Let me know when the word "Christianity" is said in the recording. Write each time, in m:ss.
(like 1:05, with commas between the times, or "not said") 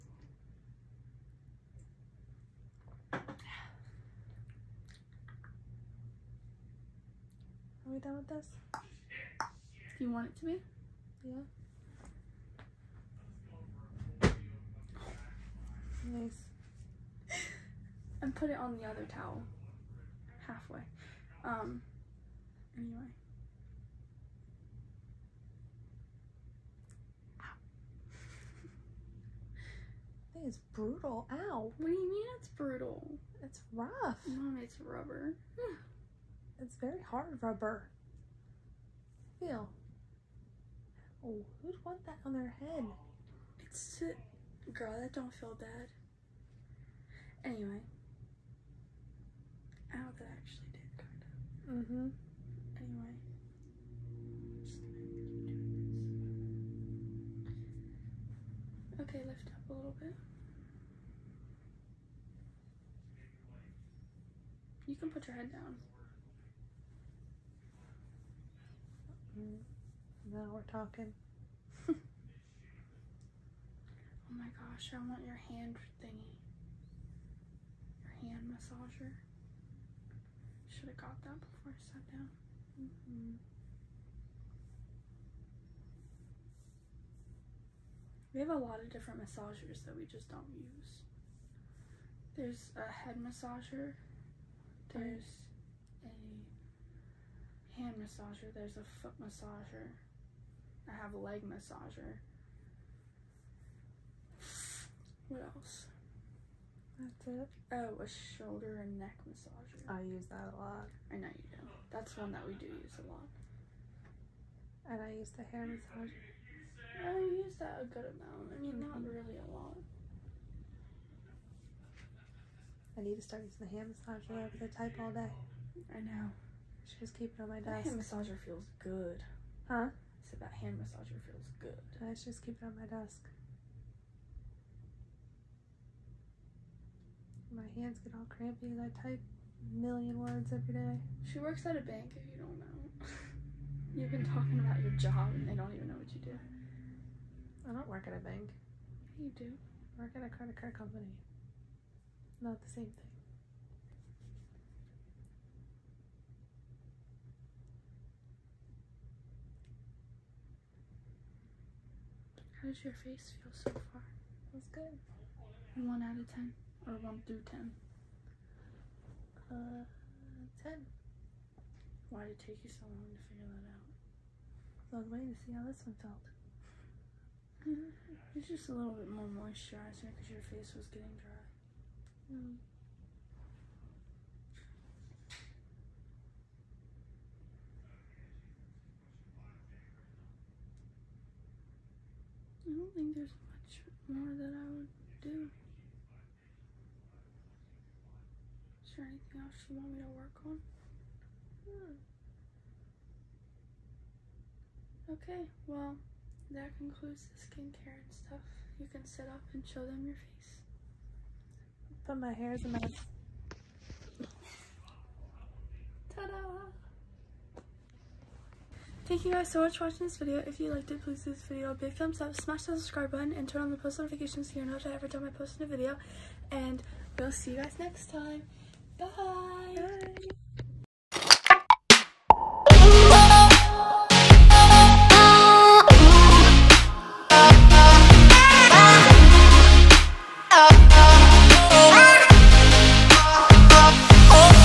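not said.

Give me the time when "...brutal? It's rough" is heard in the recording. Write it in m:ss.
0:32.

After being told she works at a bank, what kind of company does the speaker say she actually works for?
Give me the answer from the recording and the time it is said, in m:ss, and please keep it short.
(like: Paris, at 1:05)
credit card company, at 2:30.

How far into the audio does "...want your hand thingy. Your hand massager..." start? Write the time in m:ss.
1:15.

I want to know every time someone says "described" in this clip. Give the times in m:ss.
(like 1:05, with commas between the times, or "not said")
not said.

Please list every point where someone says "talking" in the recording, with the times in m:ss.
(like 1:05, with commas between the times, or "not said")
1:10, 2:24.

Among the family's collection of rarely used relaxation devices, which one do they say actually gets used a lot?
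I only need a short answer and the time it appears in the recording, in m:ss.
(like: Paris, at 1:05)
shoulder and neck massager, at 1:48.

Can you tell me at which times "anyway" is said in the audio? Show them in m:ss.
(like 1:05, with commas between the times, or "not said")
0:22, 0:47, 0:52.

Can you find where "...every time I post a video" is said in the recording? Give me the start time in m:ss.
3:44.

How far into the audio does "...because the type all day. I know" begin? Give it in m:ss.
2:04.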